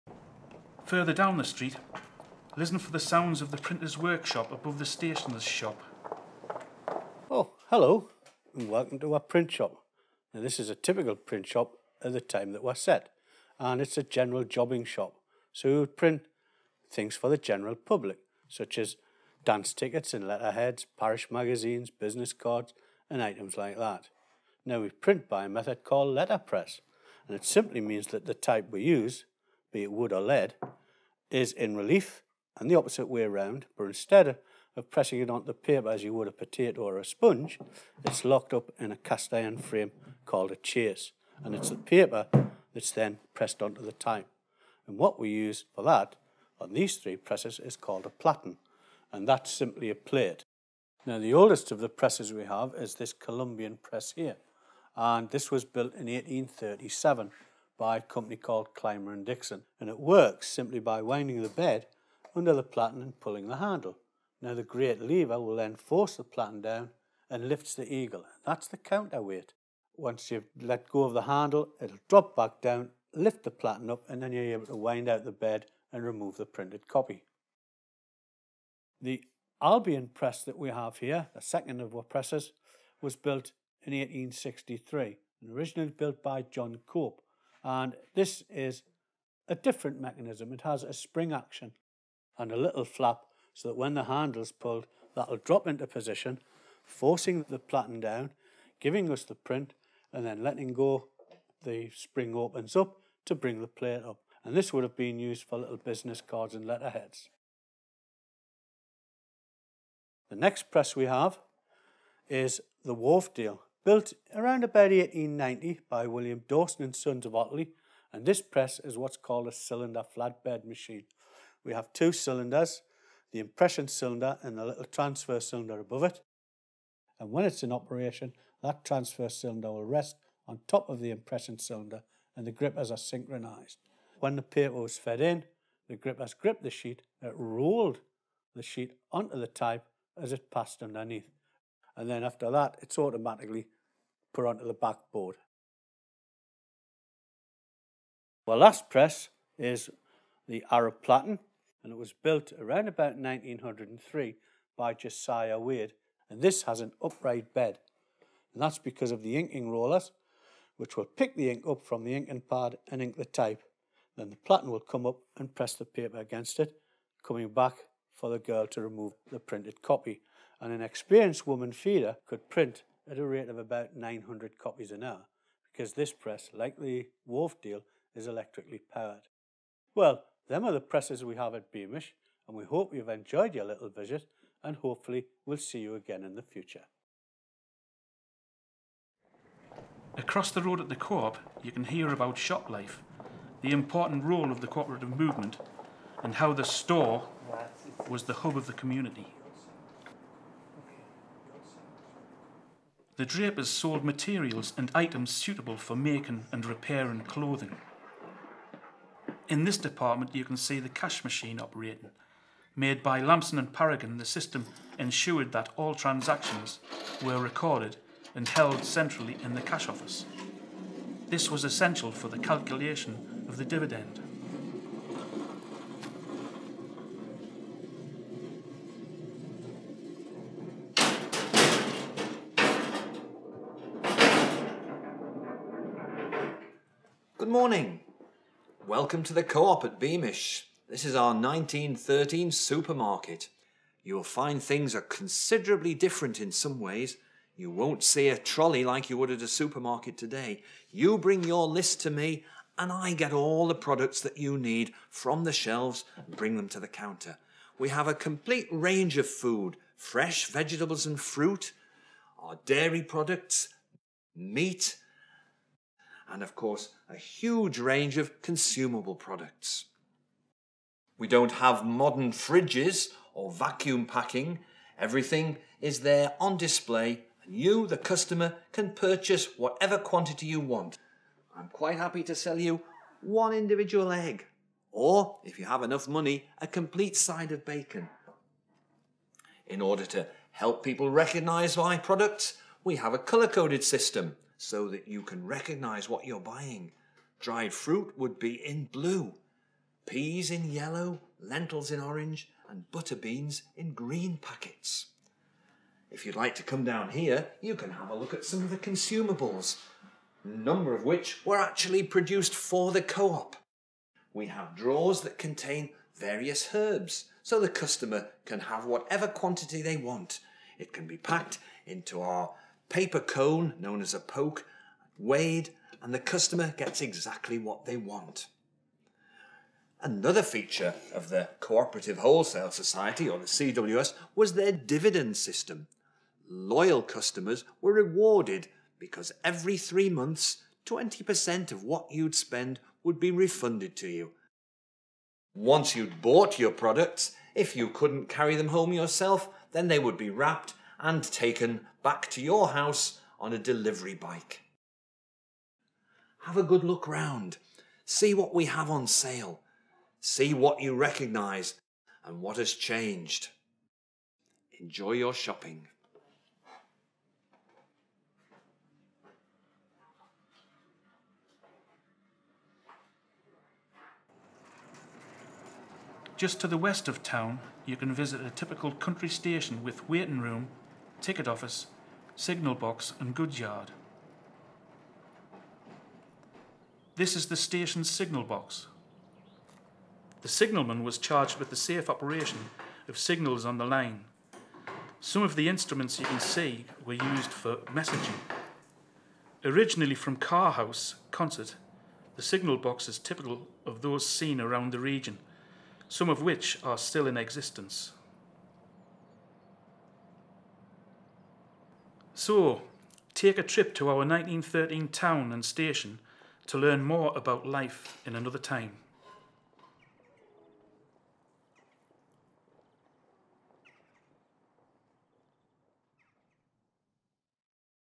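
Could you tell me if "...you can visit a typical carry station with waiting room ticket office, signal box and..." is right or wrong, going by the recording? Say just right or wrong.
wrong.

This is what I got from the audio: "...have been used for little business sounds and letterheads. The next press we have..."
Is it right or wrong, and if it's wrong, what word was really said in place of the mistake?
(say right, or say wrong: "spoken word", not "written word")
wrong: "cards", not "sounds".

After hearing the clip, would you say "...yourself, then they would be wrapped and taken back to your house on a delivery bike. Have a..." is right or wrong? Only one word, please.
right.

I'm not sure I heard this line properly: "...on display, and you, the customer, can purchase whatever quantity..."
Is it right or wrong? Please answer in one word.
right.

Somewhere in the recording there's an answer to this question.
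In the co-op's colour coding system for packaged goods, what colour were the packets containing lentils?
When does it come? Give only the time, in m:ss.
5:01.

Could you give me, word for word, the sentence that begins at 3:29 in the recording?
In this department you can see the cash machine operating.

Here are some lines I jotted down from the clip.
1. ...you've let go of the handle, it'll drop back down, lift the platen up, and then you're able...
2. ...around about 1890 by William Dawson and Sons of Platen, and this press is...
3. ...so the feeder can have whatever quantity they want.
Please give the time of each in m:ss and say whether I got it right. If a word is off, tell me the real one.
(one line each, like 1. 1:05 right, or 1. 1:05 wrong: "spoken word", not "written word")
1. 1:10 right
2. 1:54 wrong: "Otley", not "Platen"
3. 5:17 wrong: "customer", not "feeder".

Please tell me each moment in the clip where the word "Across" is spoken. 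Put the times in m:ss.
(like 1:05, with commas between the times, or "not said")
3:10.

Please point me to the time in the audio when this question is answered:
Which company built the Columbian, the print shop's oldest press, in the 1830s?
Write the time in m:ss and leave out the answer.
0:58.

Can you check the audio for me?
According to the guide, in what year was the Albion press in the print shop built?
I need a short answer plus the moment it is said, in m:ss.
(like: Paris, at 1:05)
1863, at 1:23.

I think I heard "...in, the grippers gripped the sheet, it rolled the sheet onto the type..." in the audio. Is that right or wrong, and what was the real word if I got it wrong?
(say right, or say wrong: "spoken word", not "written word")
right.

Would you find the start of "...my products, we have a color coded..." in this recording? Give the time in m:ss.
4:51.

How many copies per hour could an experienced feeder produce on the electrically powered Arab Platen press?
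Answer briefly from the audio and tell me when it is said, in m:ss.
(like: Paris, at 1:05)
900, at 2:53.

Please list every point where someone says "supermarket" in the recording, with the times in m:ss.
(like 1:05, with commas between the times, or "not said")
4:02, 4:09.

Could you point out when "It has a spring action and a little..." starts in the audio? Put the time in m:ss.
1:30.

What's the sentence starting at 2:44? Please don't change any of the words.
Then the platen will come up and press the paper against it, coming back for the girl to remove the printed copy.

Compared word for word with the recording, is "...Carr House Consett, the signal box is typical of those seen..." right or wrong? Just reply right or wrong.
right.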